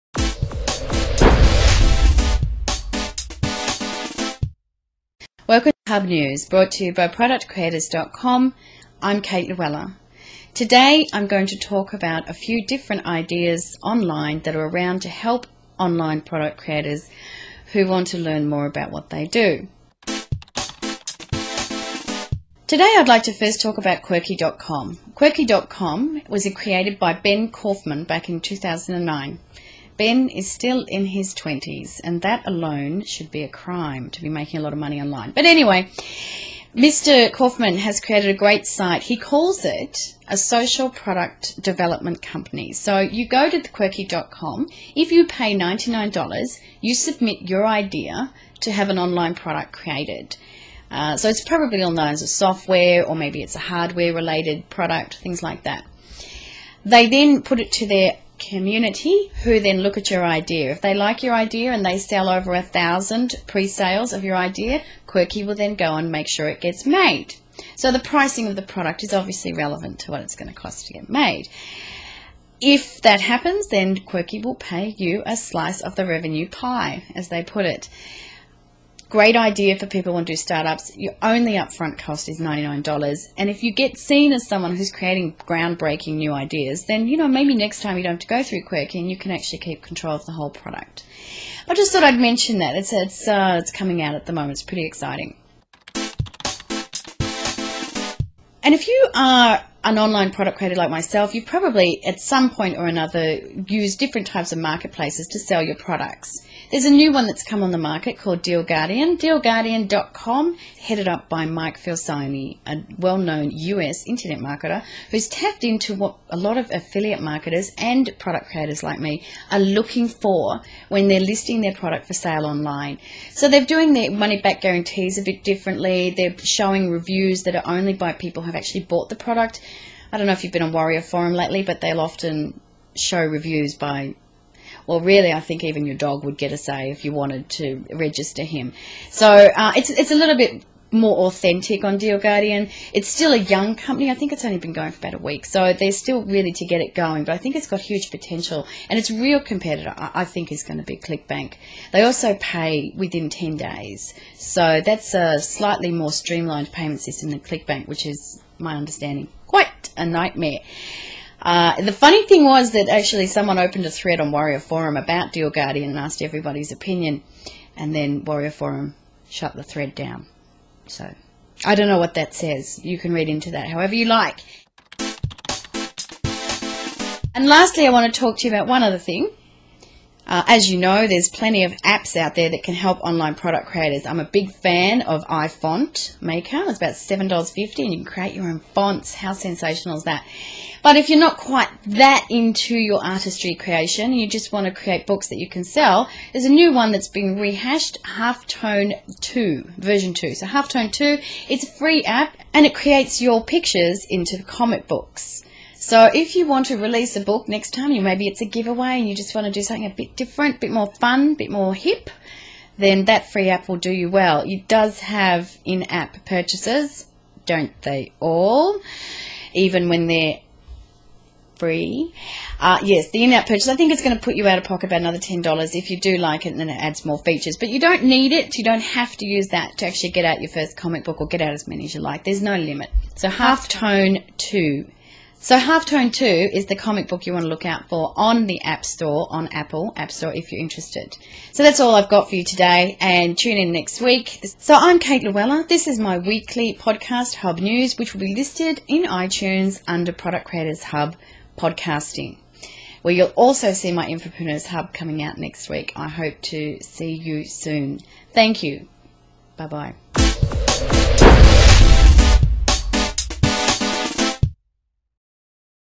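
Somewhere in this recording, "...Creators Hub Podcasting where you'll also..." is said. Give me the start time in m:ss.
4:10.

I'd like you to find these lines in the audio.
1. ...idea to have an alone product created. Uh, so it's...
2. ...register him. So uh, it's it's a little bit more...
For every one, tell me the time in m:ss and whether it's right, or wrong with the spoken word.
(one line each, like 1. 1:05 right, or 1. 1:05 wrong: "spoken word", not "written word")
1. 0:47 wrong: "online", not "alone"
2. 2:17 right.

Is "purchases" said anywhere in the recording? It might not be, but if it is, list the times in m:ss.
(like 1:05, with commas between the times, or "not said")
3:36, 3:43.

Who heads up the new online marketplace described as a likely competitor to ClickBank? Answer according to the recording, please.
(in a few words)
Mike Filsaime.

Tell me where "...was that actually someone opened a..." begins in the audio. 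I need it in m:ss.
2:42.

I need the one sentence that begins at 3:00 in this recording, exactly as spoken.
Uh, as you know, there's plenty of apps out there that can help online product creators.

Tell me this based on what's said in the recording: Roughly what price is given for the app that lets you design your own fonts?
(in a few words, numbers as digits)
$7.50.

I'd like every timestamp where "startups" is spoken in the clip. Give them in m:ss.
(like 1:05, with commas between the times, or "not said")
1:20.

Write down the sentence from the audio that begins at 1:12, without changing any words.
If that happens, then Quirky will pay you a slice of the revenue pie, as they put it.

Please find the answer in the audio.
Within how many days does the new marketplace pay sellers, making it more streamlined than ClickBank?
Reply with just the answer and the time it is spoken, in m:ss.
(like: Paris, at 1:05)
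10 days, at 2:33.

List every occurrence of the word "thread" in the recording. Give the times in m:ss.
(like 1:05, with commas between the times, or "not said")
2:43, 2:49.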